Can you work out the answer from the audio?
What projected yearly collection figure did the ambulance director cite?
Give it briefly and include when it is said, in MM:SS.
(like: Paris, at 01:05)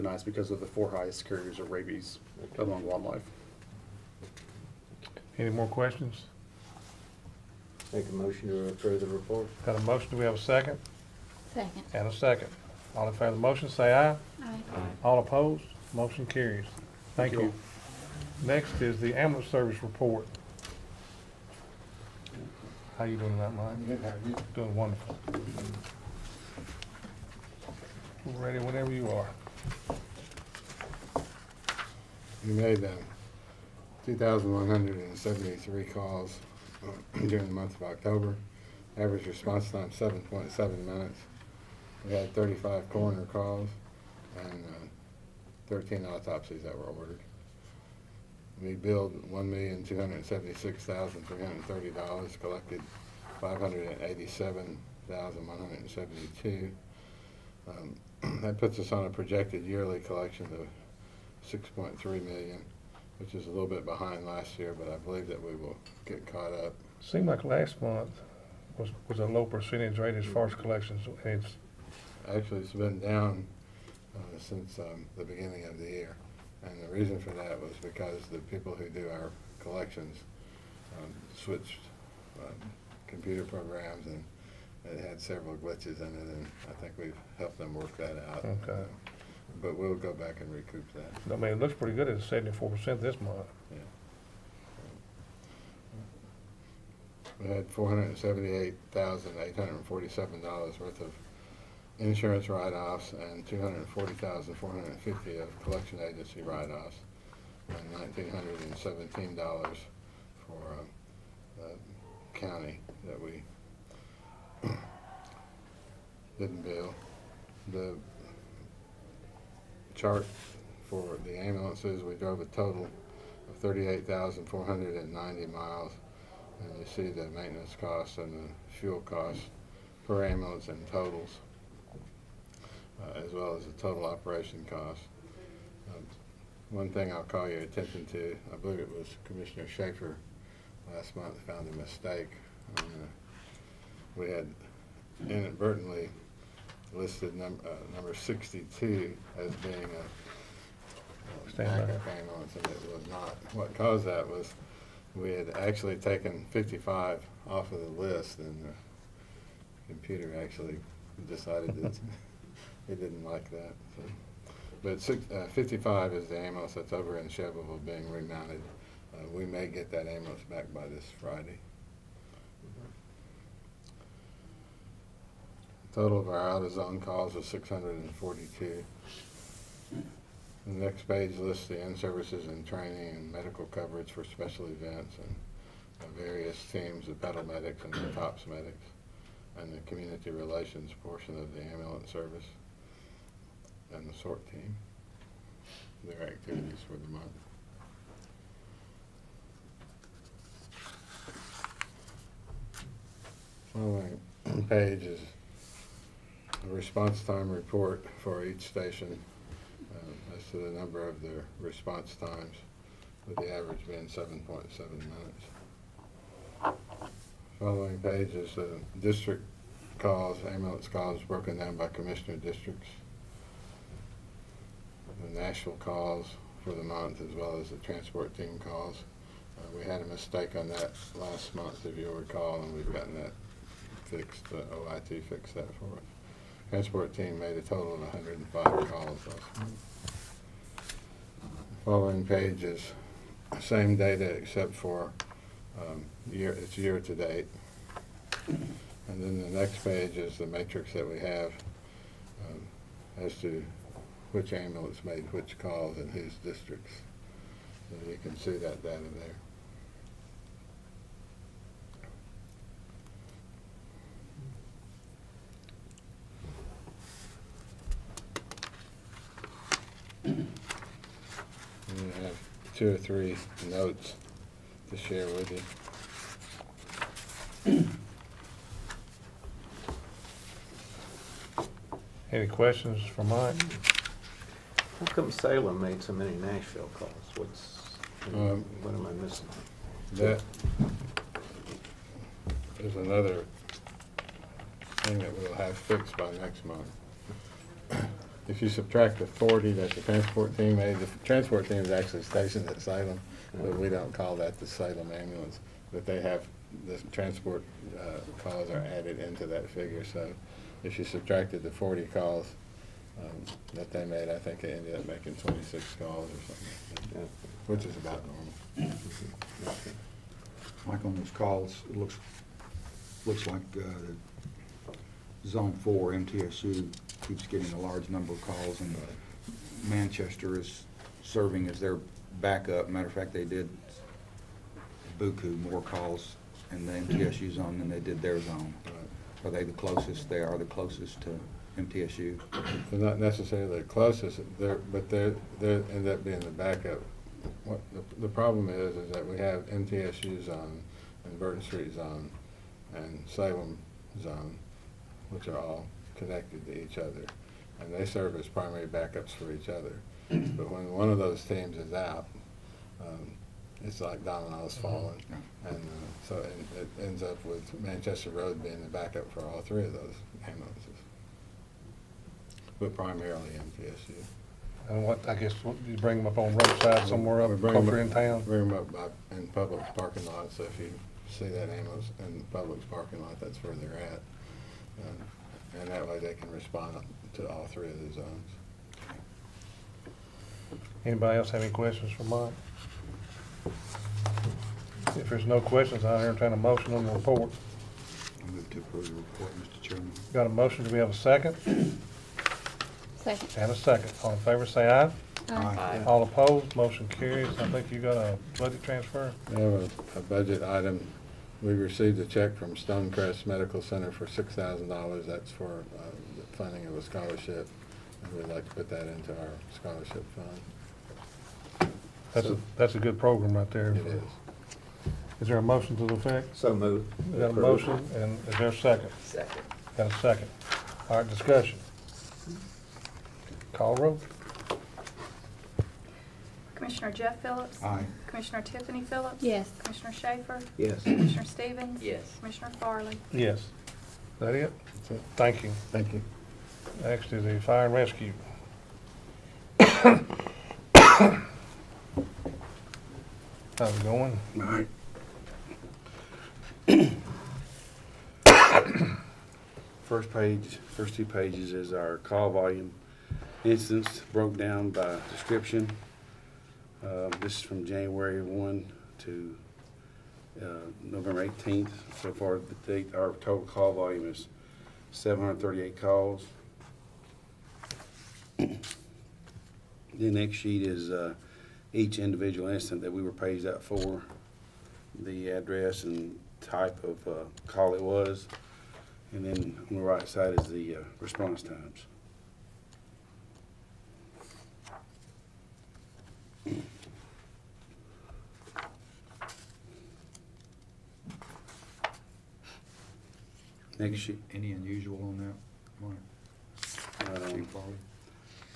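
6.3 million, at 01:01.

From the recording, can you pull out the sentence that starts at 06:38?
I move to approve the report, Mr.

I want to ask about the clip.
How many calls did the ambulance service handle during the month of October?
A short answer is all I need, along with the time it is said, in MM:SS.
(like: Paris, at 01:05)
2,173, at 00:34.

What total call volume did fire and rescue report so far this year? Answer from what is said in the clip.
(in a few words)
738.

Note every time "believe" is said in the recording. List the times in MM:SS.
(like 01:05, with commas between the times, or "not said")
01:04, 02:18.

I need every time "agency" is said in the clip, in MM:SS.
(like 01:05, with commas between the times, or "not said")
01:46.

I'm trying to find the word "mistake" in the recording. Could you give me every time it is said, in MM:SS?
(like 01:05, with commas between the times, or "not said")
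02:21, 03:50.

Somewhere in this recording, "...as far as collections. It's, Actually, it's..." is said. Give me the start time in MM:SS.
01:10.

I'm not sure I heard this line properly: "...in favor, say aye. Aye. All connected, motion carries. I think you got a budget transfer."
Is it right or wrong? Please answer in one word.
wrong.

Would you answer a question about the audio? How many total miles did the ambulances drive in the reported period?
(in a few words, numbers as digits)
38,490.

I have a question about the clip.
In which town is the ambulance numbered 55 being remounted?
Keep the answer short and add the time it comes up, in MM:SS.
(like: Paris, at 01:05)
Shelbyville, at 02:47.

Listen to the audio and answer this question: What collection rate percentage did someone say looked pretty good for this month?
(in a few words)
74 percent.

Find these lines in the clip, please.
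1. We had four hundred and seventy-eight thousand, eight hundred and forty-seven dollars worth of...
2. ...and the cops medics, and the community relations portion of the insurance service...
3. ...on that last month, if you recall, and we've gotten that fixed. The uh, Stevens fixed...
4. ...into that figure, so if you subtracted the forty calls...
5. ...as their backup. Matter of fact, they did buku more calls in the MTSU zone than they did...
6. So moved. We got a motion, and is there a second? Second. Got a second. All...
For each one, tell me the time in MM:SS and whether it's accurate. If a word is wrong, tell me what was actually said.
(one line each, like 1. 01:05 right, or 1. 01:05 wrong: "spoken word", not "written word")
1. 01:37 right
2. 03:07 wrong: "ambulance", not "insurance"
3. 03:50 wrong: "OIT", not "Stevens"
4. 05:09 right
5. 05:31 right
6. 07:06 right.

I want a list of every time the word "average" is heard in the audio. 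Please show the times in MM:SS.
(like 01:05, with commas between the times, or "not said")
00:38, 03:33.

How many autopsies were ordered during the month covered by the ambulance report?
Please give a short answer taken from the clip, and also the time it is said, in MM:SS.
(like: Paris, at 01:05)
13, at 00:45.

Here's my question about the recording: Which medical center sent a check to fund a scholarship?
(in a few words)
Stonecrest Medical Center.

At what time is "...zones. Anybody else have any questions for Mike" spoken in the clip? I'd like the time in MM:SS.
06:28.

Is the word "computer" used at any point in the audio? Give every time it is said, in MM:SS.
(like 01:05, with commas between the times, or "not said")
01:23, 02:39.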